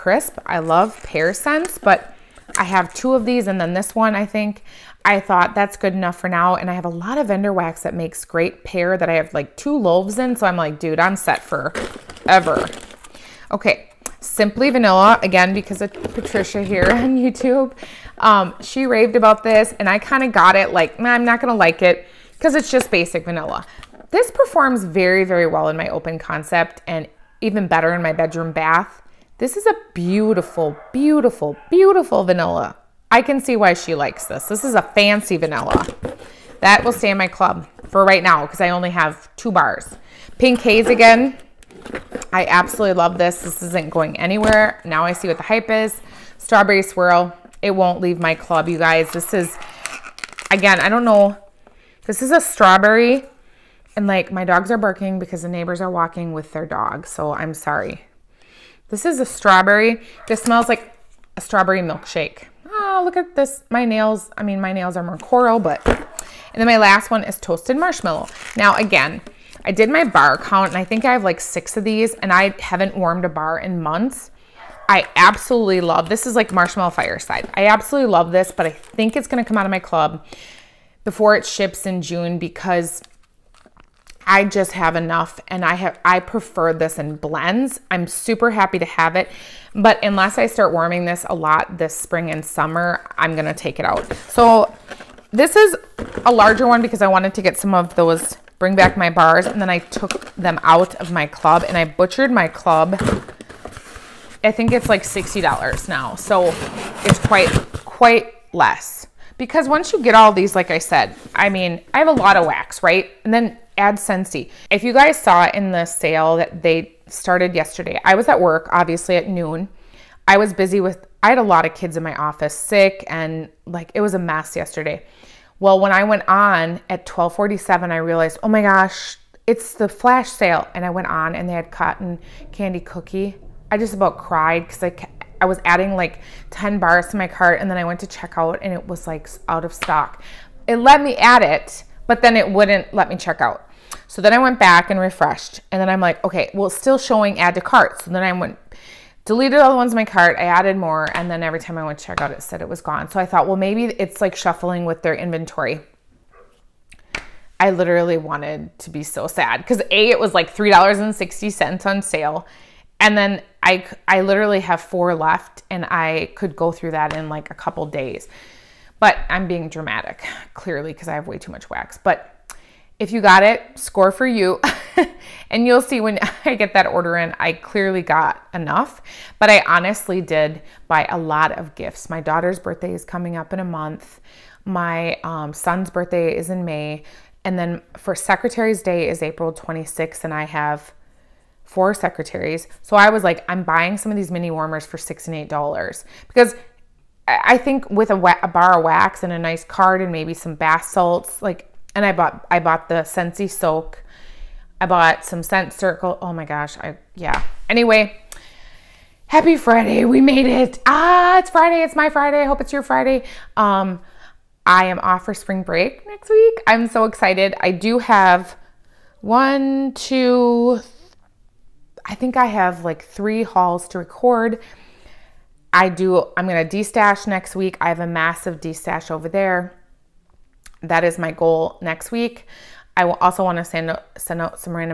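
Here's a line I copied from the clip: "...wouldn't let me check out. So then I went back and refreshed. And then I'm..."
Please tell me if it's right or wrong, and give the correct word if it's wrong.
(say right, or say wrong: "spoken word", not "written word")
right.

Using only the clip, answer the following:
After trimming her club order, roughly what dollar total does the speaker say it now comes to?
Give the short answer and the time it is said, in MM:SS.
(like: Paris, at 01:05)
$60, at 01:45.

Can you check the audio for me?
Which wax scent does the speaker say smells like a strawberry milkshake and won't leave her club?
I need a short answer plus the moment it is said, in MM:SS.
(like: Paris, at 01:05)
Strawberry Swirl, at 00:46.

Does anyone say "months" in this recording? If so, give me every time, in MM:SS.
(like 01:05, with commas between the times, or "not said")
01:13, 03:03.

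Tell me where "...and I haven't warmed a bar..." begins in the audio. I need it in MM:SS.
01:12.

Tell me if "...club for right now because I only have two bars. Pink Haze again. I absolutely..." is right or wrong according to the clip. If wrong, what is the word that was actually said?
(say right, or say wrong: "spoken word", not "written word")
right.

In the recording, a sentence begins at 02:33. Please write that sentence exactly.
So I thought, well, maybe it's like shuffling with their inventory.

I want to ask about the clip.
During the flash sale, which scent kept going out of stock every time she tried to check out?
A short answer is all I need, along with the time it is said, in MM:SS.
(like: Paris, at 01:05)
cotton candy cookie, at 02:11.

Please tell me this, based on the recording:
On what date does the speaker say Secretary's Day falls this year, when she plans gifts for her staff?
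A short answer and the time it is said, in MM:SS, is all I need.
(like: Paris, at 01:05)
April 26th, at 03:09.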